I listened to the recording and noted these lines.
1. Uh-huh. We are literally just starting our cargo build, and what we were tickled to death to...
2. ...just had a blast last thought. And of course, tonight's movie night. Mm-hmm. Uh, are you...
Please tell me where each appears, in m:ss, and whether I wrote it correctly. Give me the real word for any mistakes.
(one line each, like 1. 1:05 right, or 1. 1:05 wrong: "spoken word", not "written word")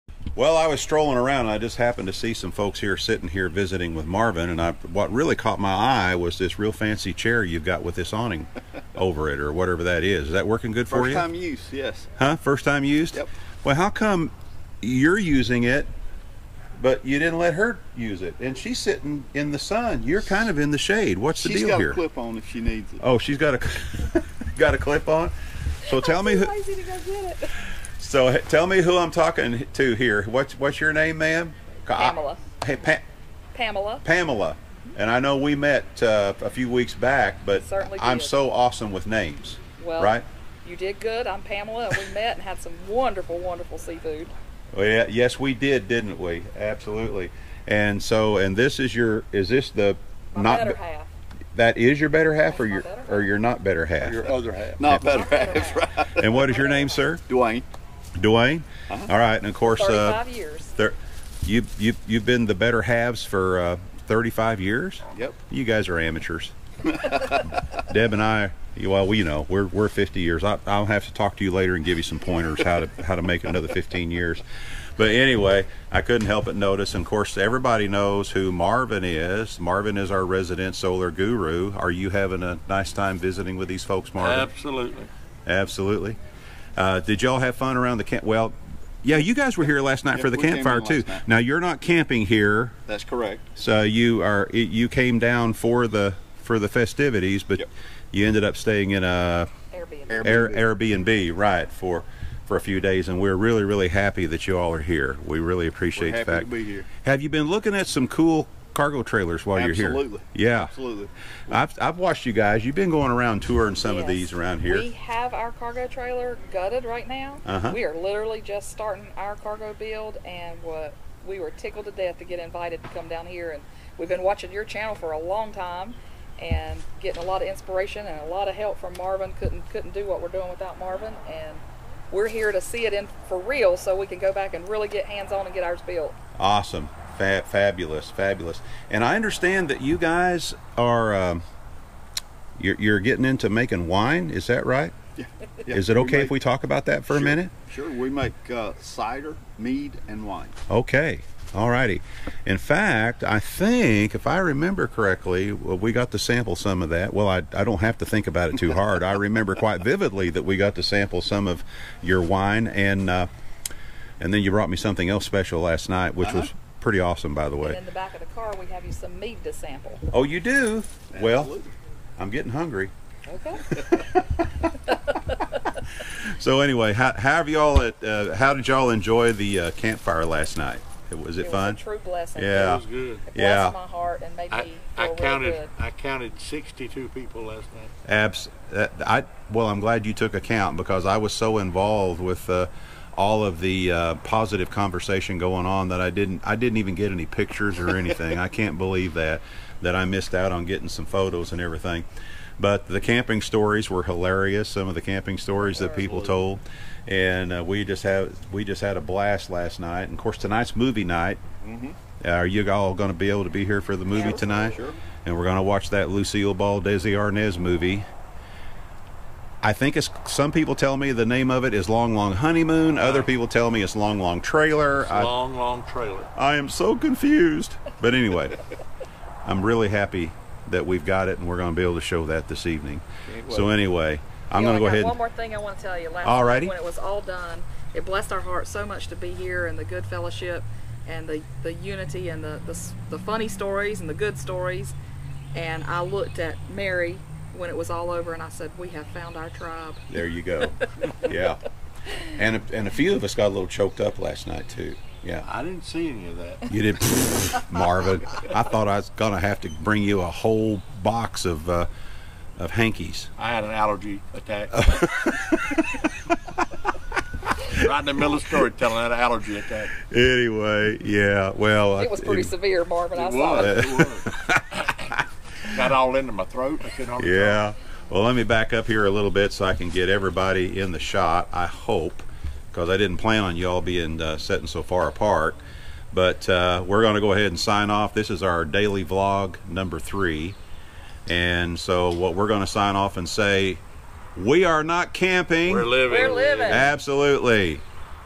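1. 1:57 right
2. 3:28 wrong: "night", not "thought".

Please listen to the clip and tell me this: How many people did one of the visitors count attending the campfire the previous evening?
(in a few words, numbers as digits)
62.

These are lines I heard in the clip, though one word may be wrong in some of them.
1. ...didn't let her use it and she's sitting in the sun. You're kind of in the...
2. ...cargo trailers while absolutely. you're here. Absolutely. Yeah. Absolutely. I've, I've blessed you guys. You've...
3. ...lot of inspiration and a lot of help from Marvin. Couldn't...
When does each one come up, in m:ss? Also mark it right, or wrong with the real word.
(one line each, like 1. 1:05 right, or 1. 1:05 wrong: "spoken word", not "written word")
1. 0:17 right
2. 1:48 wrong: "watched", not "blessed"
3. 2:07 right.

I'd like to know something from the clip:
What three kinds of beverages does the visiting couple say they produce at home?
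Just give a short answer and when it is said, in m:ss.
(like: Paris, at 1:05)
Cider, mead, and wine, at 2:28.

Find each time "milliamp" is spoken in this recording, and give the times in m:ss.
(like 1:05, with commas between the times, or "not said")
not said.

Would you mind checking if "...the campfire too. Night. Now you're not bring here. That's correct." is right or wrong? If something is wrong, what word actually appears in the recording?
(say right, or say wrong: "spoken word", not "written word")
wrong: "camping", not "bring".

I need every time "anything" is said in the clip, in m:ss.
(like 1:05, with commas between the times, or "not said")
3:17.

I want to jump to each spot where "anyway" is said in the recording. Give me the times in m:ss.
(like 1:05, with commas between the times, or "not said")
1:15, 2:56, 3:48, 3:53, 4:30.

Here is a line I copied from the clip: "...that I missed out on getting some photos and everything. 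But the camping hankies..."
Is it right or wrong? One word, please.
wrong.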